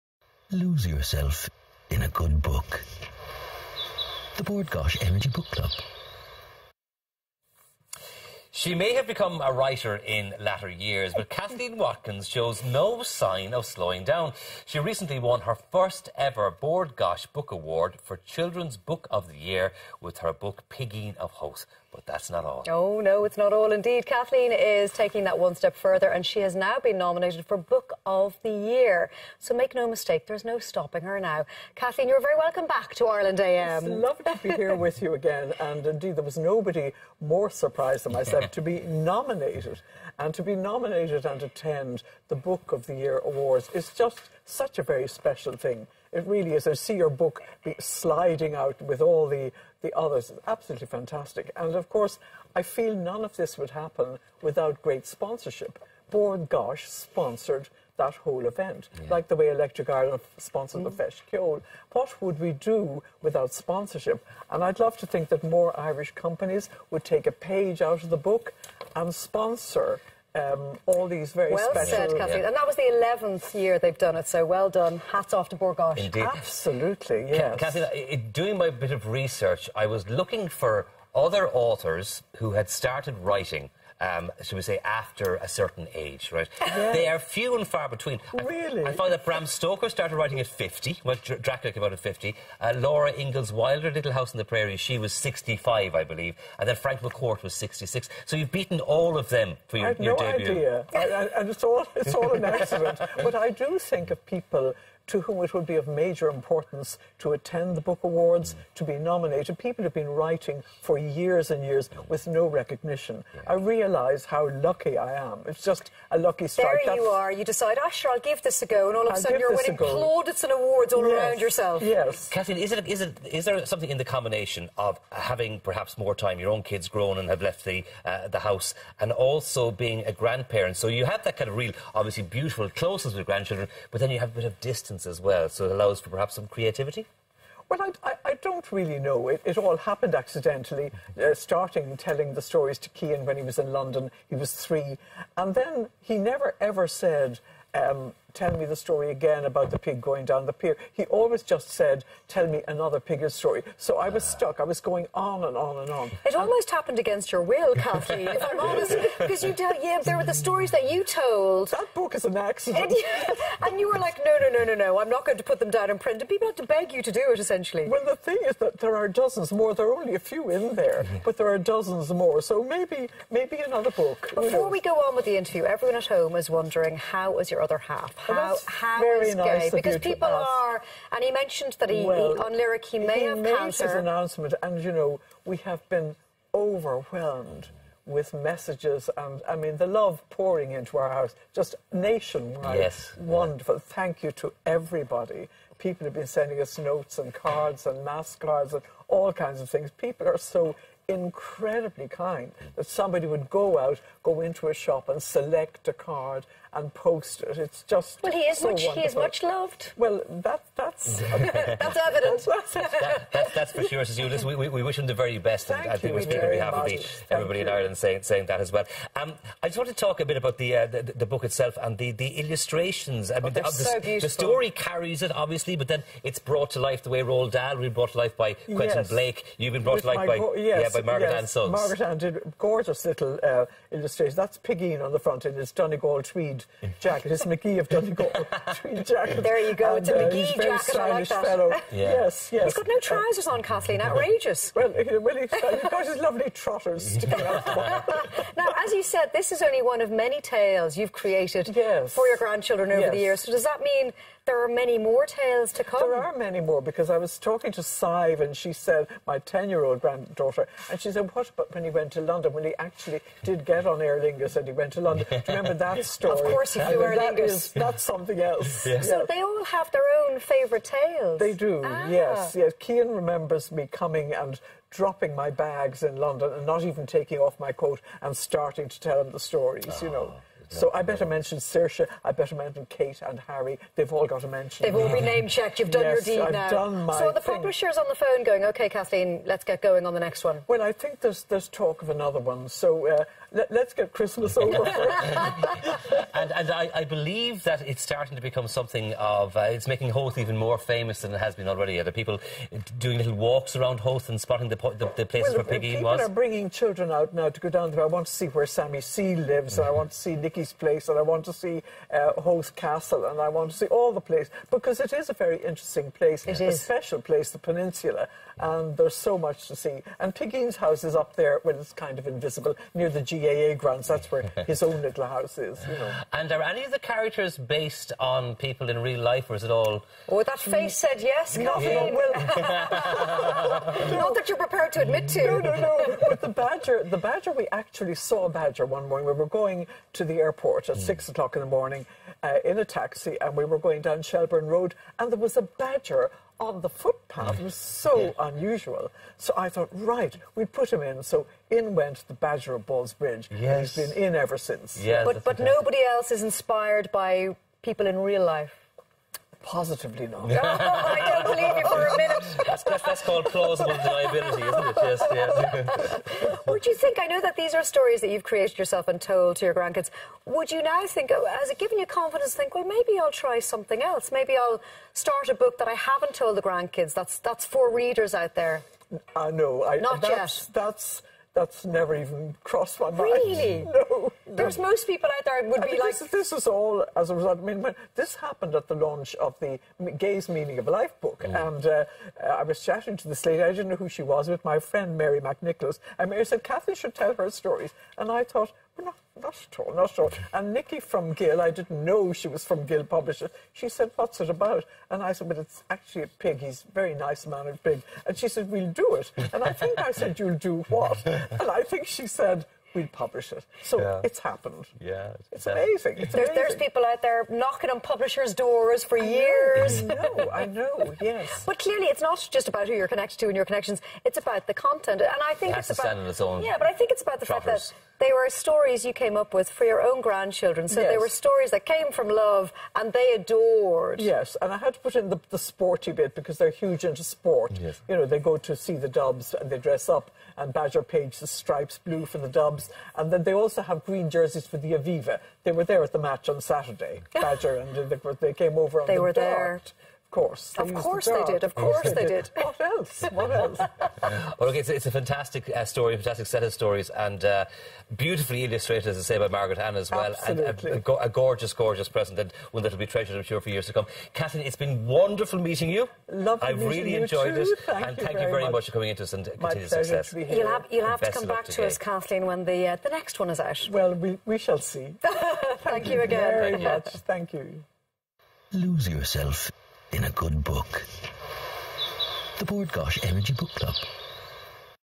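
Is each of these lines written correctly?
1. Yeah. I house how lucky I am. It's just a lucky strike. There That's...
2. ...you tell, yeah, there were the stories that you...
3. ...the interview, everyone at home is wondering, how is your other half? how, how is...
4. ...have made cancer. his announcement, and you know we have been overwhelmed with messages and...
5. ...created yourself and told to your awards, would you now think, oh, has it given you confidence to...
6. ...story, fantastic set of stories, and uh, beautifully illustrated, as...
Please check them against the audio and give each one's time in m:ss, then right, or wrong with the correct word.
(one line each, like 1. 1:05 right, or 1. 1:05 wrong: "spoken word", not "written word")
1. 1:53 wrong: "realise", not "house"
2. 2:39 right
3. 2:55 right
4. 3:03 right
5. 6:08 wrong: "grandkids", not "awards"
6. 7:35 right.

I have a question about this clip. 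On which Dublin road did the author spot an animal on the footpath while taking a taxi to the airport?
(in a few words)
Shelburne Road.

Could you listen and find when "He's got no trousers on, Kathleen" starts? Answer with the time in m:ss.
4:02.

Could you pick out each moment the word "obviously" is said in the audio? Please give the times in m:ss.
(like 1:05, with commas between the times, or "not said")
2:11, 3:45.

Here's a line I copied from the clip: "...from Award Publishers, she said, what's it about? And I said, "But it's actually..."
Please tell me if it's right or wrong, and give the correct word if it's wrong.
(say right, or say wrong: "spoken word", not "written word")
wrong: "Gill", not "Award".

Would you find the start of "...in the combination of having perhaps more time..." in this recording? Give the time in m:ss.
2:03.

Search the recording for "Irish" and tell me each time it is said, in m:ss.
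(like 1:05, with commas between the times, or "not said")
1:05.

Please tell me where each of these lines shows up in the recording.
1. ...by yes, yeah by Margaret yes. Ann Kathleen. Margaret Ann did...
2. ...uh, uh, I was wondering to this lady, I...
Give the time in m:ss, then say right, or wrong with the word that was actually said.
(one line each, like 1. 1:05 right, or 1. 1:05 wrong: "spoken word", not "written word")
1. 3:50 wrong: "Suggs", not "Kathleen"
2. 6:31 wrong: "chatting", not "wondering".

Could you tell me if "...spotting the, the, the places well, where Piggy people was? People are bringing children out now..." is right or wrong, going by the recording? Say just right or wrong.
right.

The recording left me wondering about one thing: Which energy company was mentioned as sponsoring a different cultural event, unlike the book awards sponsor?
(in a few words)
Electric Ireland.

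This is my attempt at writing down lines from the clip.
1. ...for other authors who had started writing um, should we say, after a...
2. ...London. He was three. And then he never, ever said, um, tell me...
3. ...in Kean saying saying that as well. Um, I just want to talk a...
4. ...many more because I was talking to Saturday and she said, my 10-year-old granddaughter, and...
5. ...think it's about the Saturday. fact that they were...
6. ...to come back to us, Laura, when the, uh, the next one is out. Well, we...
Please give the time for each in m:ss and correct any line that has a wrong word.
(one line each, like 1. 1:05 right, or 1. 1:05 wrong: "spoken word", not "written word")
1. 1:20 right
2. 2:23 right
3. 3:37 wrong: "Ireland", not "Kean"
4. 4:16 wrong: "Sive", not "Saturday"
5. 7:06 wrong: "Trotters", not "Saturday"
6. 7:51 wrong: "Kathleen", not "Laura".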